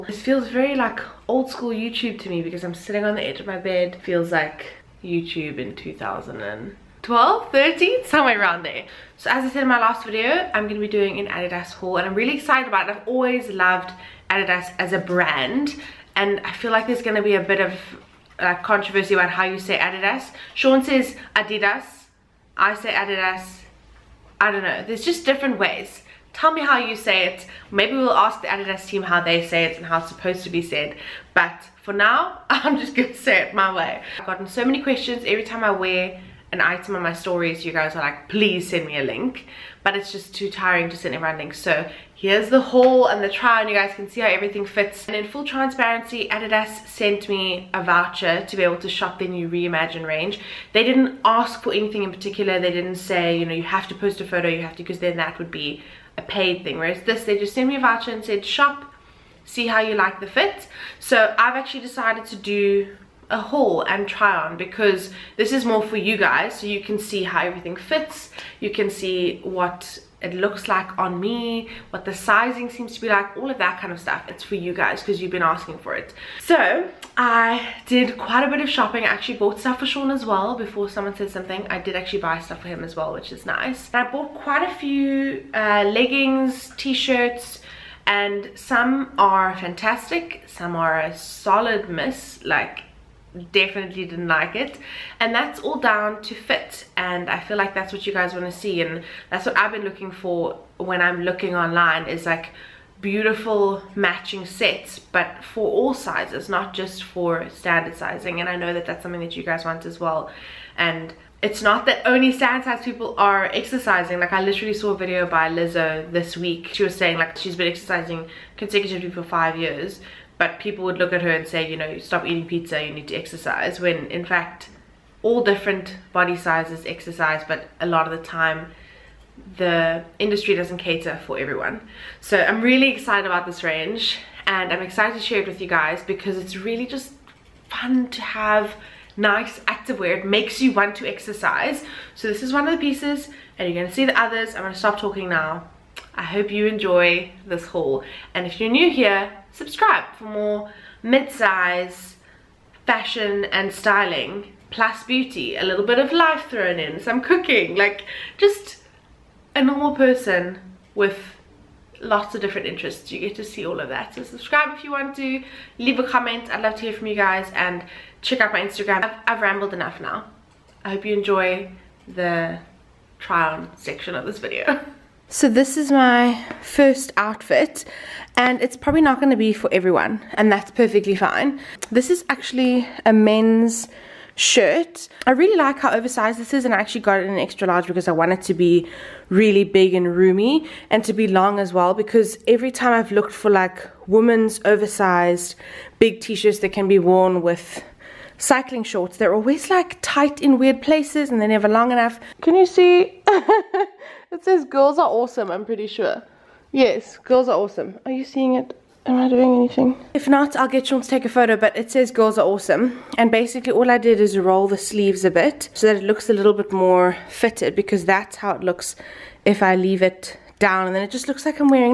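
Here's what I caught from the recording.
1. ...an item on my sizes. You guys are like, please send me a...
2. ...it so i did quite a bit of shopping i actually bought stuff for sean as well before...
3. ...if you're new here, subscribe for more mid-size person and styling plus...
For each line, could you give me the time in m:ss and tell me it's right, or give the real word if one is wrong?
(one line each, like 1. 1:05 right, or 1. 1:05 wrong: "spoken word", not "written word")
1. 0:36 wrong: "stories", not "sizes"
2. 1:15 right
3. 2:28 wrong: "fashion", not "person".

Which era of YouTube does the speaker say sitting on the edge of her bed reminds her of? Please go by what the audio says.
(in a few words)
2012.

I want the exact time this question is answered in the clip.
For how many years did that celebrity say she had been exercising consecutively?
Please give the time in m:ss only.
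1:59.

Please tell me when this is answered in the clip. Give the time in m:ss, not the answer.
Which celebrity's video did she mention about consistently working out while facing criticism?
1:55.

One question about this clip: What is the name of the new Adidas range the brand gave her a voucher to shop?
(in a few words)
Reimagine.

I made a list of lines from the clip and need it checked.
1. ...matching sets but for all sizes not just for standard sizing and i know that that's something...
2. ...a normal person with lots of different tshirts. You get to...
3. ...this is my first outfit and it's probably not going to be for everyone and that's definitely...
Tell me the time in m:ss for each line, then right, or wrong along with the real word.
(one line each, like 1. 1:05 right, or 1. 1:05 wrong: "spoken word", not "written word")
1. 1:43 right
2. 2:39 wrong: "interests", not "tshirts"
3. 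2:55 wrong: "perfectly", not "definitely".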